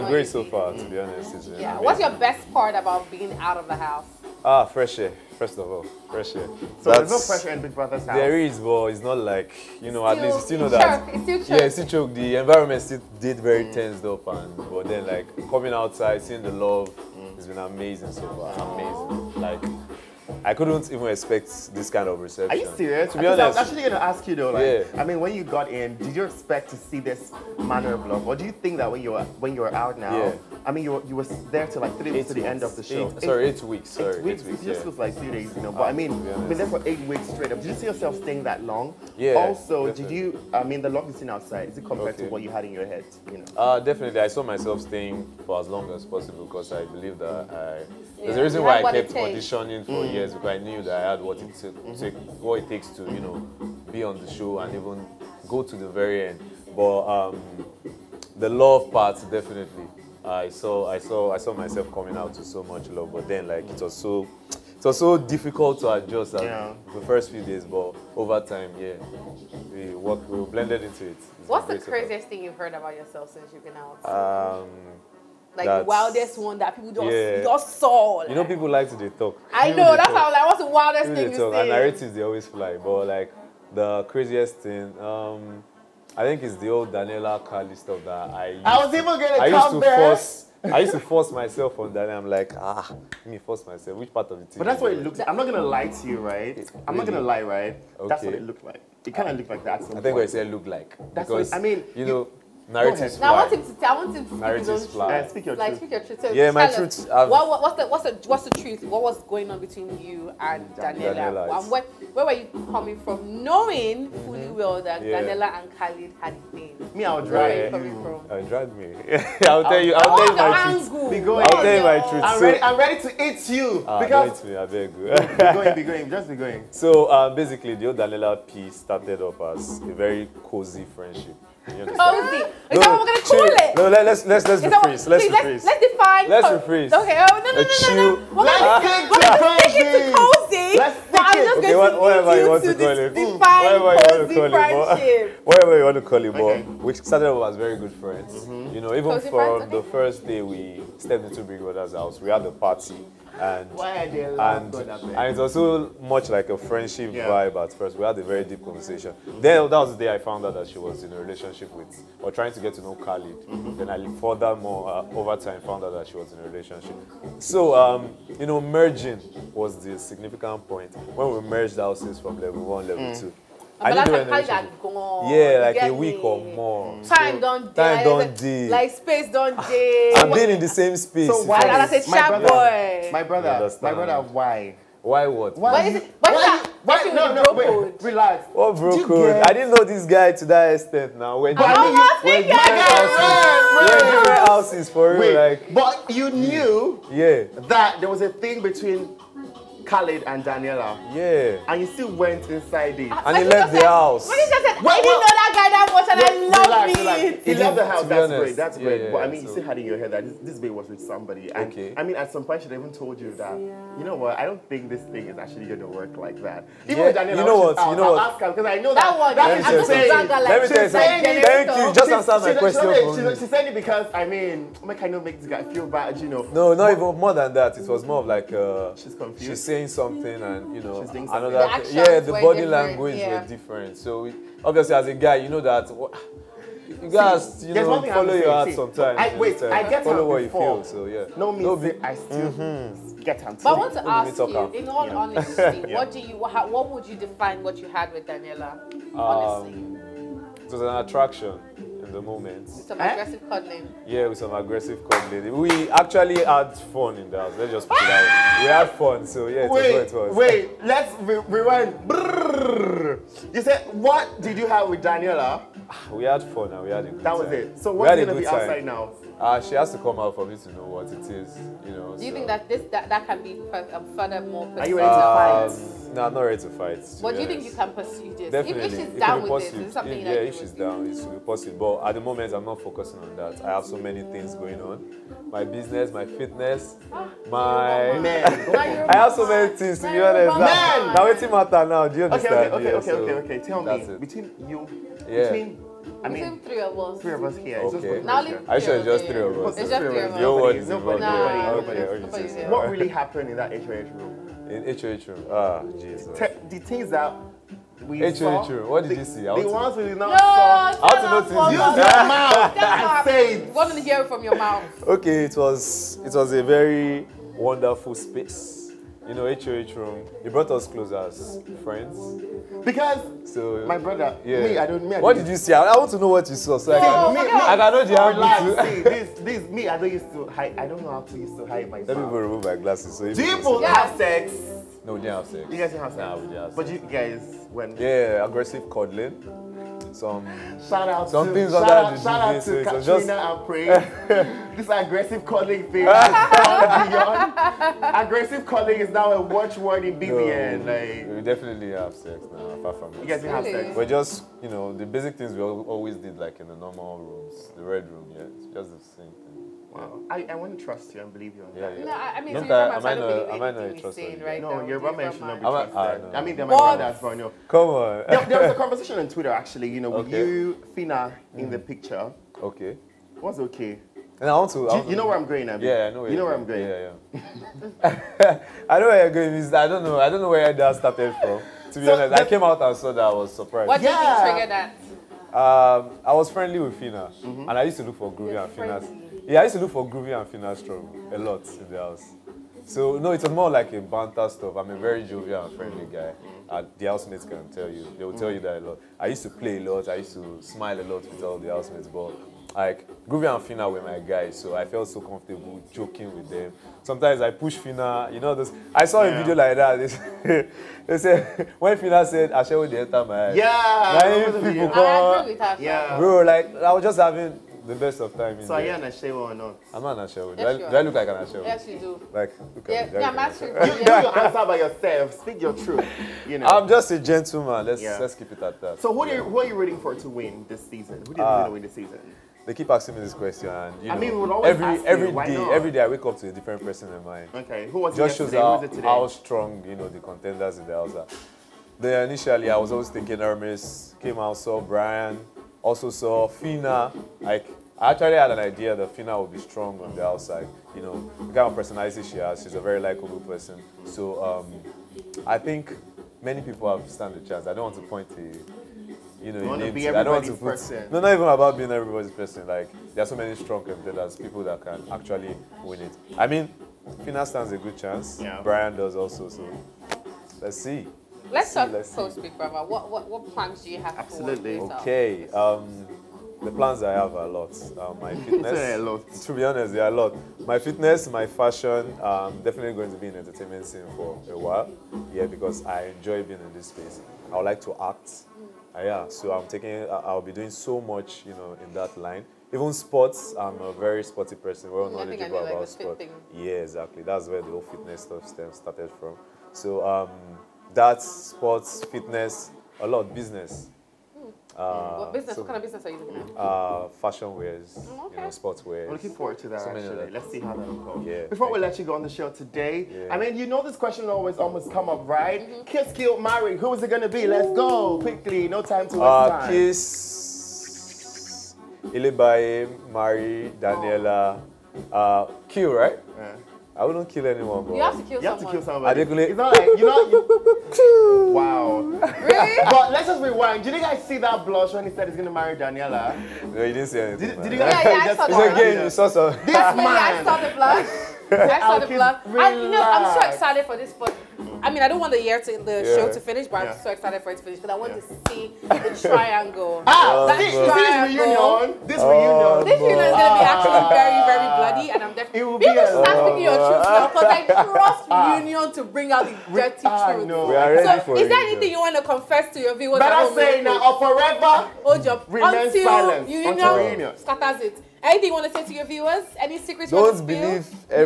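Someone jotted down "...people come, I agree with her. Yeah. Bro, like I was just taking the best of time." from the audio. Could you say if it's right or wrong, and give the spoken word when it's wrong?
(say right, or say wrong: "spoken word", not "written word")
wrong: "having", not "taking".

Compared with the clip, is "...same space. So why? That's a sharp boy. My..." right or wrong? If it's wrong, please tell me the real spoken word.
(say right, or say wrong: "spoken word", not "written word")
right.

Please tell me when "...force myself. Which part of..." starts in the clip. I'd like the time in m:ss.
1:33.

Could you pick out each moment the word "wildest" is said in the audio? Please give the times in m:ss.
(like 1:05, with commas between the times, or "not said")
1:15, 1:20.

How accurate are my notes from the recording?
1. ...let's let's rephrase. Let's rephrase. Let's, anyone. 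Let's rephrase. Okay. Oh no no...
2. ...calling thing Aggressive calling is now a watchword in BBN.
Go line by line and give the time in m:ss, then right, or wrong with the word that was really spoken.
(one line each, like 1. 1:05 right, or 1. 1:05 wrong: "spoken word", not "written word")
1. 2:14 wrong: "define", not "anyone"
2. 5:45 right.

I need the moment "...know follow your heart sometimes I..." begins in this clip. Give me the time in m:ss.
3:57.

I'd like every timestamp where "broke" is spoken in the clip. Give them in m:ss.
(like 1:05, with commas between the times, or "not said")
not said.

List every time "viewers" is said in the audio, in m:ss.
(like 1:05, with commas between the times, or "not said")
9:22, 9:29.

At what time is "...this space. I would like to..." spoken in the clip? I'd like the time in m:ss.
8:06.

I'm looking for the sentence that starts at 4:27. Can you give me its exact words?
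So what's going to be time.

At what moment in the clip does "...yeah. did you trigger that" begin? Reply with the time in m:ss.
6:24.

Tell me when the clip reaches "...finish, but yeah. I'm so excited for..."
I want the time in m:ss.
9:06.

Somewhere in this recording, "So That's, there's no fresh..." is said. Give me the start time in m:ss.
0:06.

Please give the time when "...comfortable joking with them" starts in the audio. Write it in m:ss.
6:45.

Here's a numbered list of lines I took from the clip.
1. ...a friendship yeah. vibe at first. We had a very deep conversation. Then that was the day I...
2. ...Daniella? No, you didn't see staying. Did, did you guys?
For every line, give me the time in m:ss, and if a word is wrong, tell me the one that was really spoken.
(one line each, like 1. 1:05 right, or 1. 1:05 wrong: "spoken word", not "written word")
1. 2:36 right
2. 8:55 wrong: "anything", not "staying".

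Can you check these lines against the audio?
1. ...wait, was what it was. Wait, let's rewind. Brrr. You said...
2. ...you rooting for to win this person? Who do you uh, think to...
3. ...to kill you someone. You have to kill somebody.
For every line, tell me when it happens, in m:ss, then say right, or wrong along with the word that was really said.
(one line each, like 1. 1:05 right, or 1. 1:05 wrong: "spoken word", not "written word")
1. 4:19 right
2. 7:09 wrong: "season", not "person"
3. 8:48 right.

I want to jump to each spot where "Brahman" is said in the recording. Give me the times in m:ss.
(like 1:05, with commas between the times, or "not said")
6:04.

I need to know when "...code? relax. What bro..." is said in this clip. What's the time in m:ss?
3:07.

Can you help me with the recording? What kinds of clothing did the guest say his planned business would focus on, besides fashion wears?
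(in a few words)
Sports wears.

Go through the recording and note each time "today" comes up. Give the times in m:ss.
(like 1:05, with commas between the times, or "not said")
7:18, 8:32.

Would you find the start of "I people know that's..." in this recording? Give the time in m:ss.
1:19.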